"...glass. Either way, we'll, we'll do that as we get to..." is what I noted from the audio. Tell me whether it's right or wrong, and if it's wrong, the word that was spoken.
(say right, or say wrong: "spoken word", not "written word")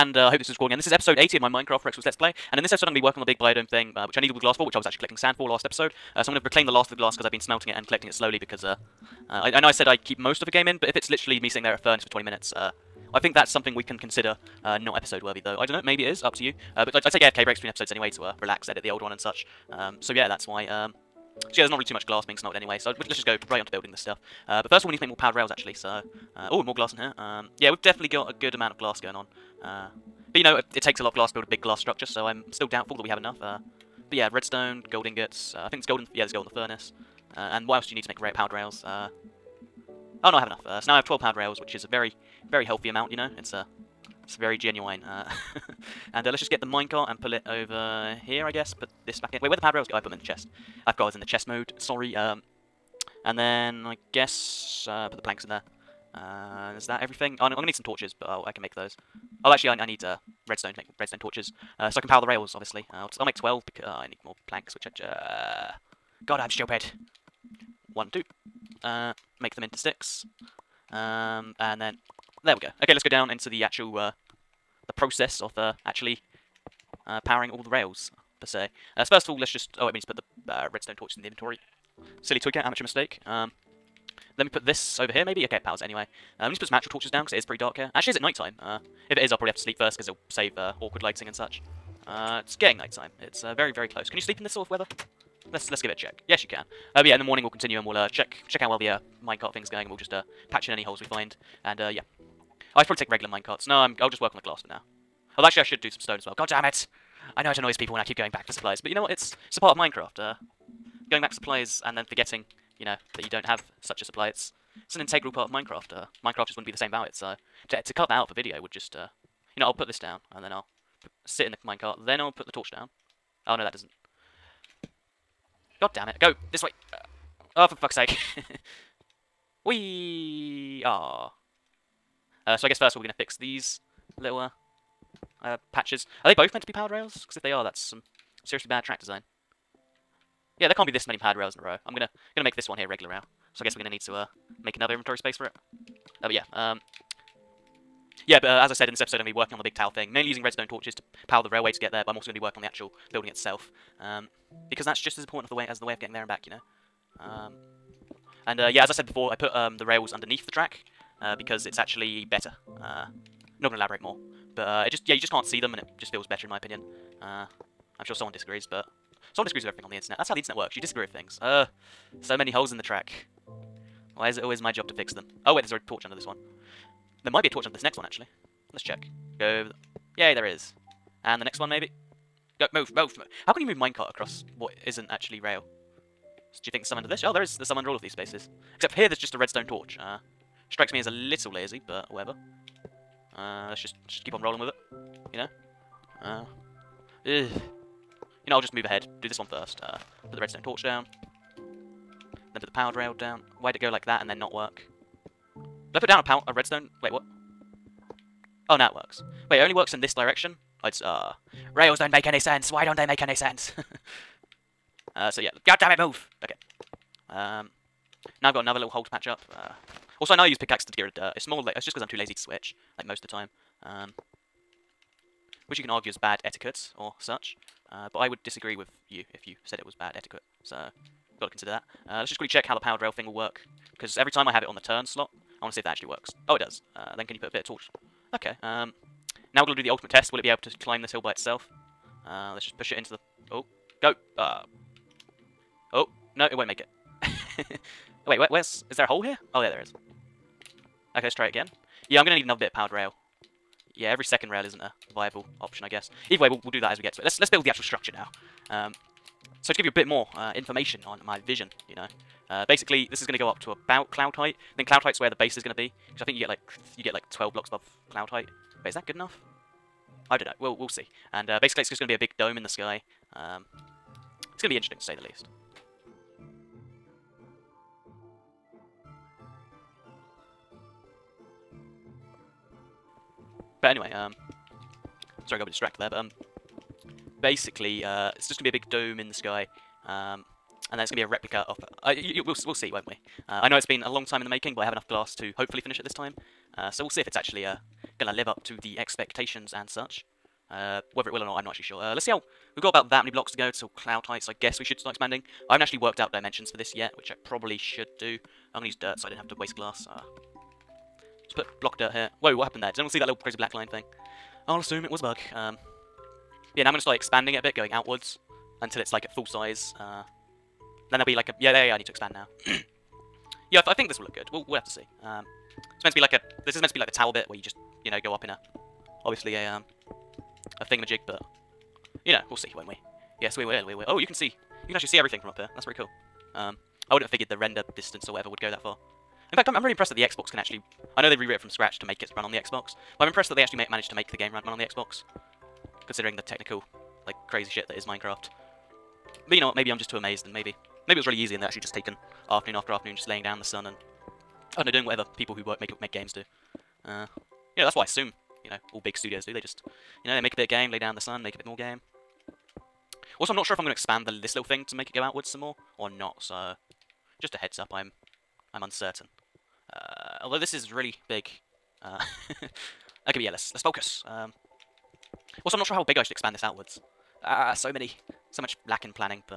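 wrong: "guess", not "glass".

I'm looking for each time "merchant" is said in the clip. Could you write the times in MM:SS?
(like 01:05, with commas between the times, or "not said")
not said.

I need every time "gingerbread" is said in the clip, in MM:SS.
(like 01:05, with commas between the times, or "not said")
not said.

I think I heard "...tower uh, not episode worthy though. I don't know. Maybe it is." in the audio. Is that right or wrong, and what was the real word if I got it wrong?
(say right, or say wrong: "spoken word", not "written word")
wrong: "consider", not "tower".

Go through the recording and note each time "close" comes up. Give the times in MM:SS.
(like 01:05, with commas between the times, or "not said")
01:33.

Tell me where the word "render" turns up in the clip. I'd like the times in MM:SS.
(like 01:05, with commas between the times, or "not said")
05:37.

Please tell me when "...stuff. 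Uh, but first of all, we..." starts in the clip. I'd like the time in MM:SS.
00:23.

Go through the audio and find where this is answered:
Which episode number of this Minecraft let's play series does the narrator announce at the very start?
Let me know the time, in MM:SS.
00:00.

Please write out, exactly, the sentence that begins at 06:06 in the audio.
So, just a heads up, I'm I'm uncertain.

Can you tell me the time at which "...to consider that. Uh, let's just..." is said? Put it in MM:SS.
03:51.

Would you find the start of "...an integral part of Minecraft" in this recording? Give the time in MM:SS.
01:54.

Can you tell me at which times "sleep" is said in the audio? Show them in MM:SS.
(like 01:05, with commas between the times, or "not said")
01:29, 01:34.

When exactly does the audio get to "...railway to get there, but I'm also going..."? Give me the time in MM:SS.
02:31.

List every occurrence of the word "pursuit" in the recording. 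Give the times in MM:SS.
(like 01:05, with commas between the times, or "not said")
not said.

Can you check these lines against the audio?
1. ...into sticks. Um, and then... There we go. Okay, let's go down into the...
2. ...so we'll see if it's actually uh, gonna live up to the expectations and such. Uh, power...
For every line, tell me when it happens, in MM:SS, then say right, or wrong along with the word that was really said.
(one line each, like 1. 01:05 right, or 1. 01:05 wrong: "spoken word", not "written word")
1. 01:09 right
2. 04:56 wrong: "whether", not "power".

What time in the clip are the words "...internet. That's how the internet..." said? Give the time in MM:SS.
02:49.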